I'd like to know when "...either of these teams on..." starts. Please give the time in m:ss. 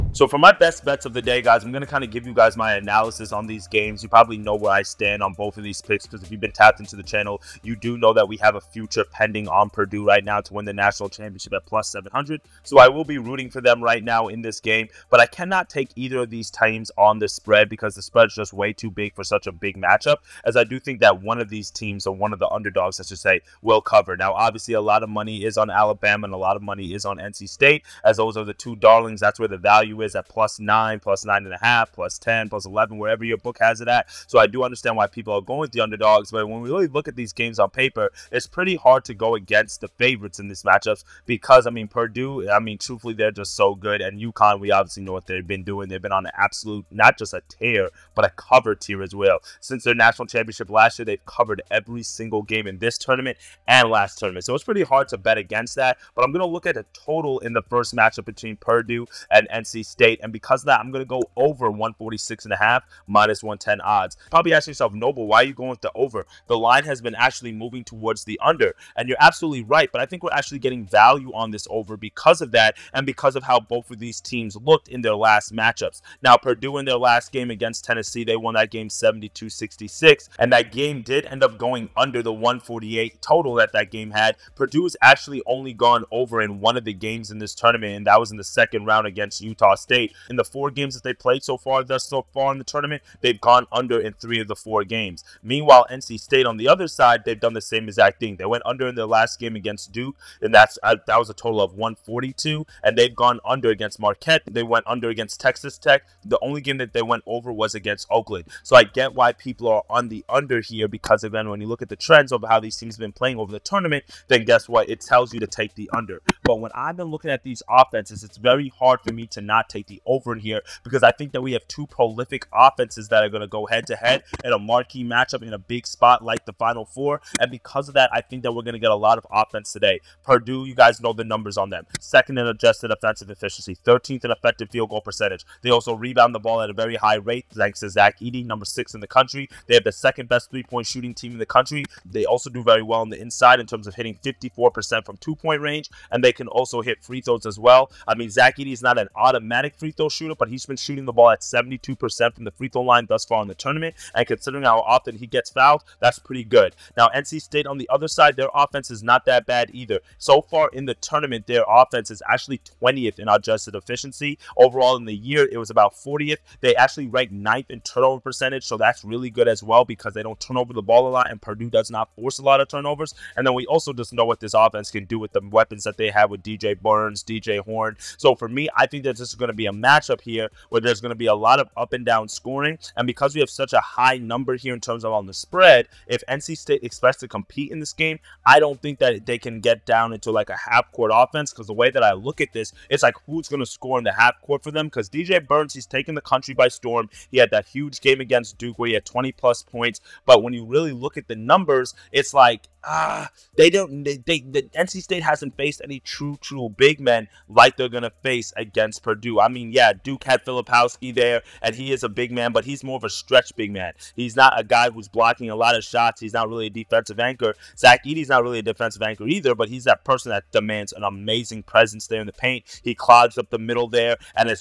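0:15.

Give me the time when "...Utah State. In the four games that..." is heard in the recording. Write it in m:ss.
1:29.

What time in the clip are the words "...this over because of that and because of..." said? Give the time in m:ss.
1:11.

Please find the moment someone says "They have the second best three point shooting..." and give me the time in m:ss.
2:19.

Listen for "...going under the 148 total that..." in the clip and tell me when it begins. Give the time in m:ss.
1:21.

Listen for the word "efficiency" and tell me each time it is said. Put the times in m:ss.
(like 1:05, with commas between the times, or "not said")
2:13, 2:43.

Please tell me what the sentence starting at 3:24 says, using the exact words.
They, they the NC State hasn't faced any true, true big men like they're gonna face against Purdue.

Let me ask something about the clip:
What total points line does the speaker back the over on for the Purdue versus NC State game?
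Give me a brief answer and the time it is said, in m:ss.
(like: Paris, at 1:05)
146.5, at 1:01.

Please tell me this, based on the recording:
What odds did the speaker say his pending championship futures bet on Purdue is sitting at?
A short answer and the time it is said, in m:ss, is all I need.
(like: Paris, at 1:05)
+700, at 0:11.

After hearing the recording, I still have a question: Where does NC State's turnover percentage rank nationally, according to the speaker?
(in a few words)
9th.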